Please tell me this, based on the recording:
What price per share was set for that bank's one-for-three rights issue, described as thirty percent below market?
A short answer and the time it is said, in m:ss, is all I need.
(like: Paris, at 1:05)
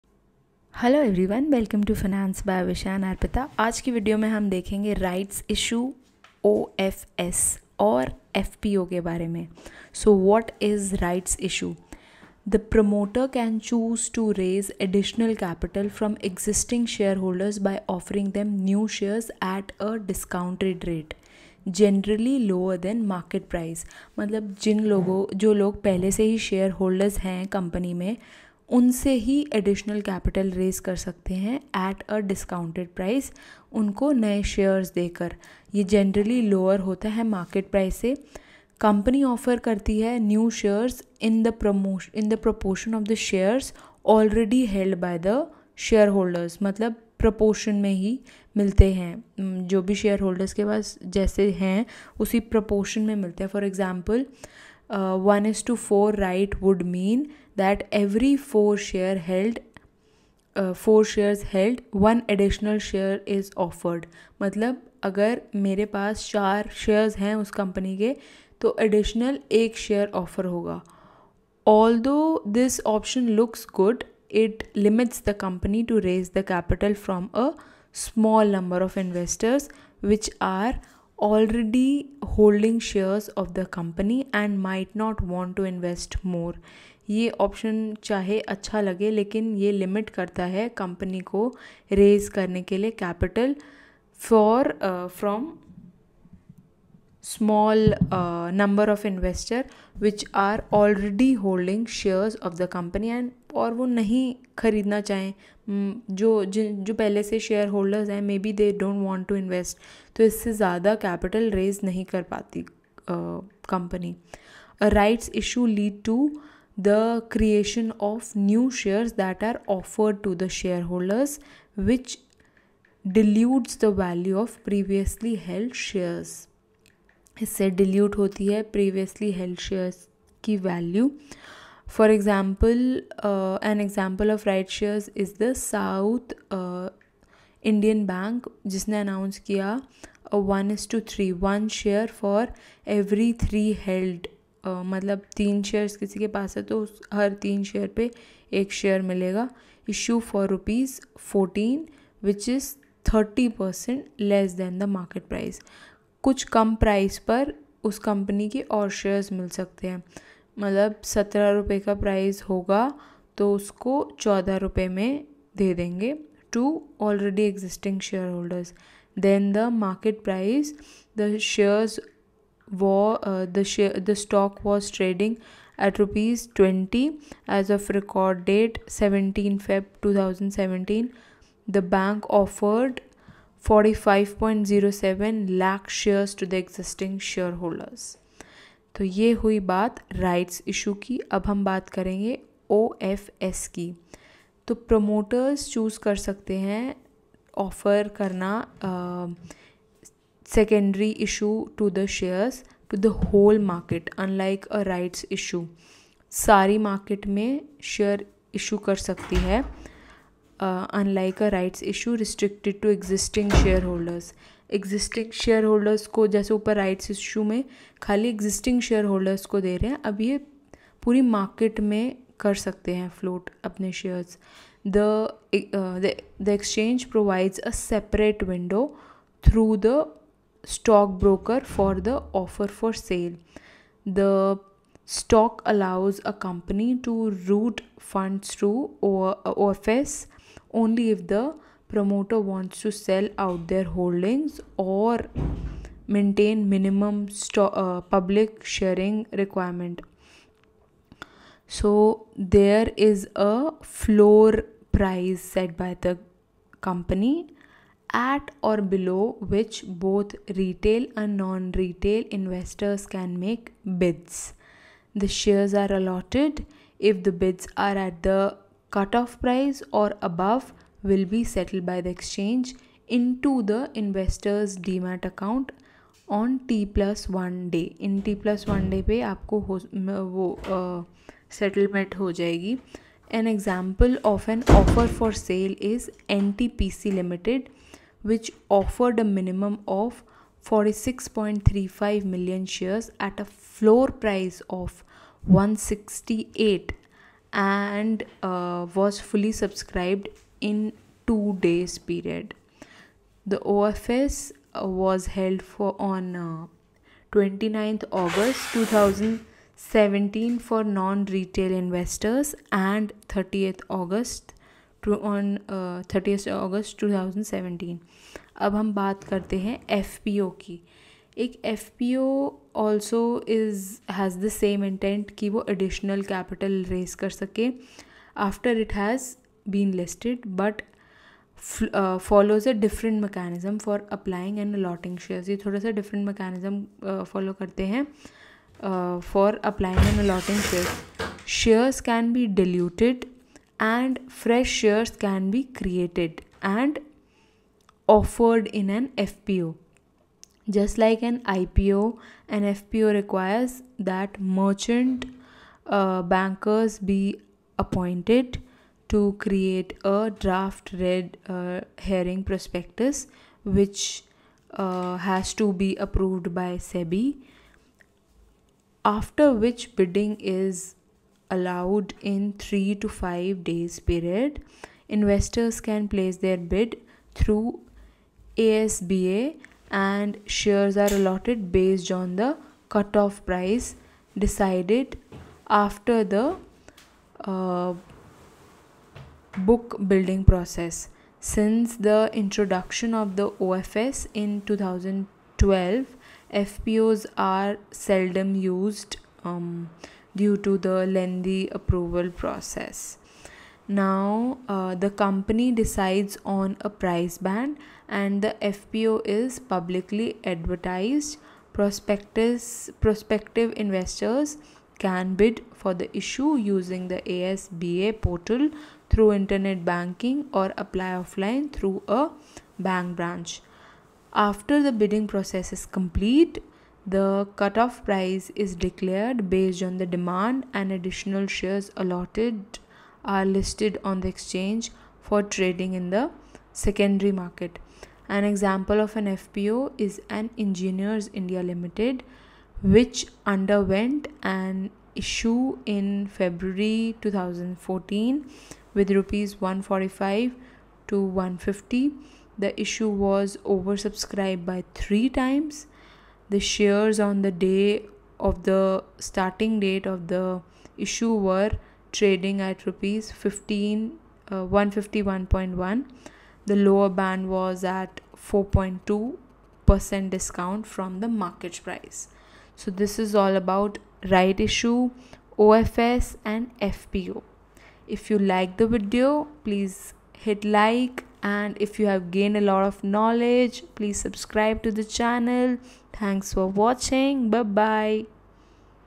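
Rs 14, at 2:30.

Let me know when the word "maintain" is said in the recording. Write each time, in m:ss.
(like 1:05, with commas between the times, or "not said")
4:06.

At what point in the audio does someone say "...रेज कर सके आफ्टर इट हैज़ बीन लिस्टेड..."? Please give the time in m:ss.
5:26.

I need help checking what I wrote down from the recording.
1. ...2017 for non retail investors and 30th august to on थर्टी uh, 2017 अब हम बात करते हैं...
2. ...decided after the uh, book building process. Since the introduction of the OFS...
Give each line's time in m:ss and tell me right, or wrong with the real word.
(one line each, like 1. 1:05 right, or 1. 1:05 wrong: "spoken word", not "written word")
1. 5:08 right
2. 6:24 right.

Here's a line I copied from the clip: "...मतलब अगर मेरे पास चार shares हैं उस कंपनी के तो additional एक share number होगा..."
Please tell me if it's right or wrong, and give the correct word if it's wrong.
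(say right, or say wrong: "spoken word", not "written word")
wrong: "offer", not "number".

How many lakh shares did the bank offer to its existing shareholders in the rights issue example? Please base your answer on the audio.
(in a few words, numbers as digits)
45.07 lakh.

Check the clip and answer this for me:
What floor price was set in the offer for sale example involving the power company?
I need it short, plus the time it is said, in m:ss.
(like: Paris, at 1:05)
168, at 4:55.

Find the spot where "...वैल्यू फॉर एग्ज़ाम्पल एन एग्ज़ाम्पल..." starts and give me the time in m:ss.
2:10.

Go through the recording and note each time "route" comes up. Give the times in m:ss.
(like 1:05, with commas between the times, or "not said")
3:57.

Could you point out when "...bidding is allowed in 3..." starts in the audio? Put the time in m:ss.
6:09.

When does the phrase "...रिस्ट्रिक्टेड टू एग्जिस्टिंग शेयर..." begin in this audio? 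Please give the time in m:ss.
3:32.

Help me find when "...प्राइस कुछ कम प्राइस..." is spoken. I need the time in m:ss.
2:35.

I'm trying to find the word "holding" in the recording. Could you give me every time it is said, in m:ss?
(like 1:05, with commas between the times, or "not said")
1:22, 1:41, 4:03.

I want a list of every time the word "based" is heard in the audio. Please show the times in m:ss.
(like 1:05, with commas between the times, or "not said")
6:21, 7:09.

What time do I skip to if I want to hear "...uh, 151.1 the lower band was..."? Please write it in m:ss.
7:44.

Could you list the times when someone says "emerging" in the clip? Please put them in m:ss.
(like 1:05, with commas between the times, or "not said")
not said.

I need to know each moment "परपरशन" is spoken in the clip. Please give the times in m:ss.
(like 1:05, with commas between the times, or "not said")
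0:42, 0:47, 0:52.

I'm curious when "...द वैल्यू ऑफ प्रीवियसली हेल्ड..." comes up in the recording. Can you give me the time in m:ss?
2:03.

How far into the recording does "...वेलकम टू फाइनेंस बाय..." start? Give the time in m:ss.
0:01.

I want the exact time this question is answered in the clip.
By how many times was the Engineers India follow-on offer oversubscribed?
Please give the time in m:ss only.
7:34.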